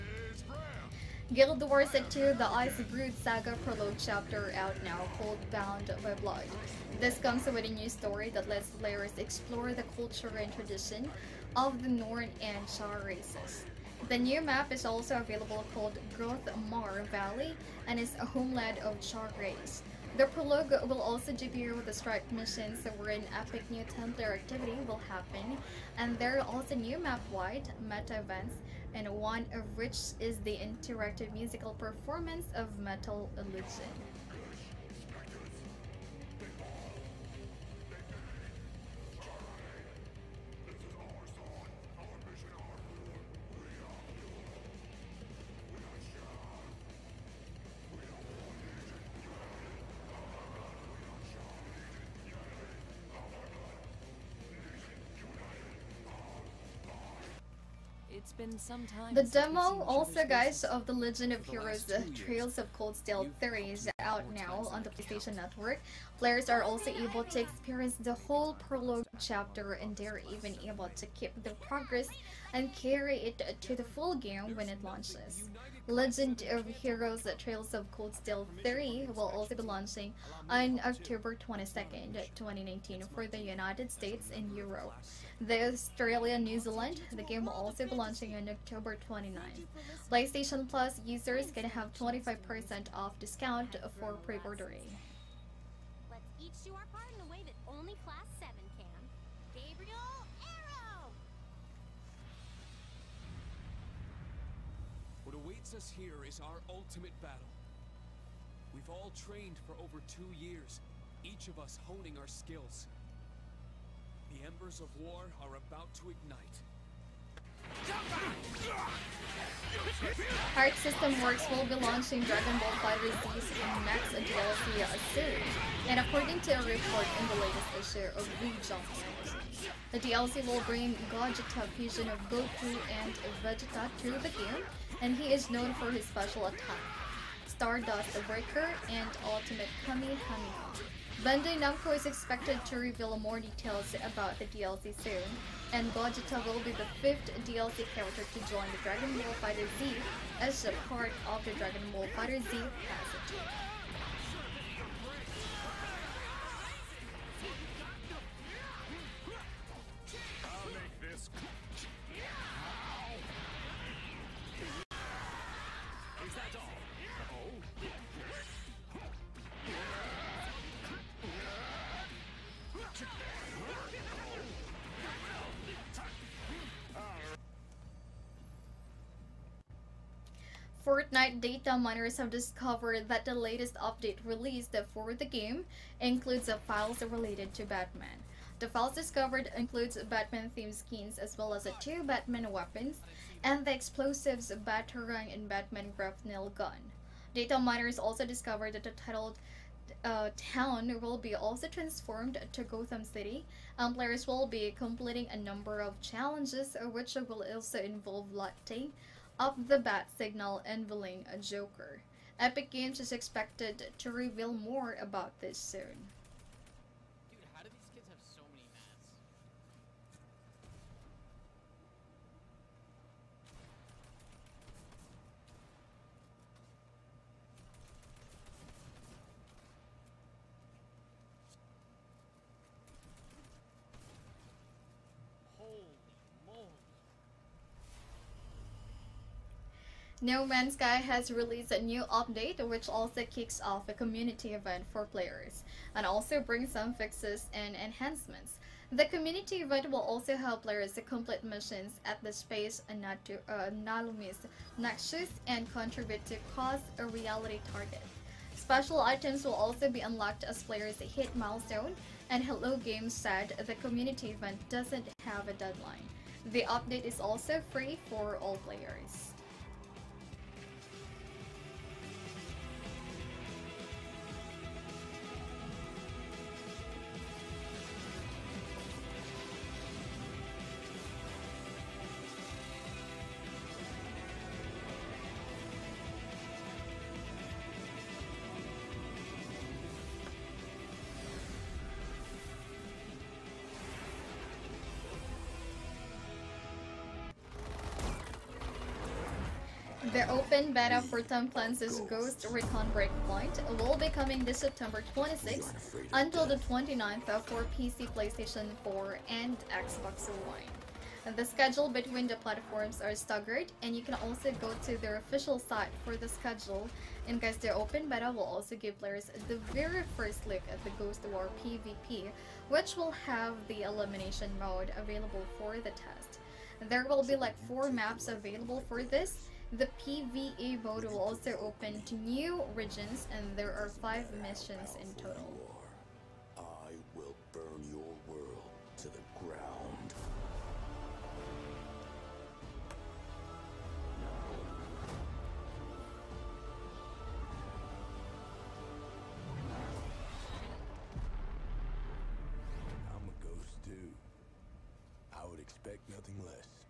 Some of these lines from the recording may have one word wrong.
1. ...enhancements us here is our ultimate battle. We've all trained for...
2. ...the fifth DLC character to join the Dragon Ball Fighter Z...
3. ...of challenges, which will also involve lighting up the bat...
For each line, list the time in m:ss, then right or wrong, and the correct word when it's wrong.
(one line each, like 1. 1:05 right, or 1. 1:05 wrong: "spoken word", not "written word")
1. 1:45 wrong: "awaits", not "enhancements"
2. 2:26 right
3. 3:25 right.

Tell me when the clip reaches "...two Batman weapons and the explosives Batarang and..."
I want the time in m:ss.
3:11.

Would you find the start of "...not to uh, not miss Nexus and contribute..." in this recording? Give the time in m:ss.
4:13.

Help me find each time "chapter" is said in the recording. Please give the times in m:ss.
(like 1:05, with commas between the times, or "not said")
0:03, 1:09.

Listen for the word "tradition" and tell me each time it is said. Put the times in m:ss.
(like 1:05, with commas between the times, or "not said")
0:10.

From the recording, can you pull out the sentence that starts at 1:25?
The Australia New Zealand, the game will also be launching on October 29th.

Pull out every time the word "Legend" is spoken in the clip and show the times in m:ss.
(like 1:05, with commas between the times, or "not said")
1:00, 1:15.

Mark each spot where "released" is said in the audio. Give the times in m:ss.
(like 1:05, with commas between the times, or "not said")
3:04, 4:01.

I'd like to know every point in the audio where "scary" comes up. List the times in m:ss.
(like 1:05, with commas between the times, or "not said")
not said.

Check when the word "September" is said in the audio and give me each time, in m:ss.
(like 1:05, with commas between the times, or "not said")
5:04.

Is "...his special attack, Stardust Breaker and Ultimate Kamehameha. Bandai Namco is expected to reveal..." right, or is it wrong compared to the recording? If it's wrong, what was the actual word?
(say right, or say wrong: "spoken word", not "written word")
right.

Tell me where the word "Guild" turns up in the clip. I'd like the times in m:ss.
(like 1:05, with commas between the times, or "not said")
0:01.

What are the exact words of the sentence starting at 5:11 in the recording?
The schedule between the platforms are staggered, and you can also go to their official site for the schedule.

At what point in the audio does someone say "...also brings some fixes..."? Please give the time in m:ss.
4:06.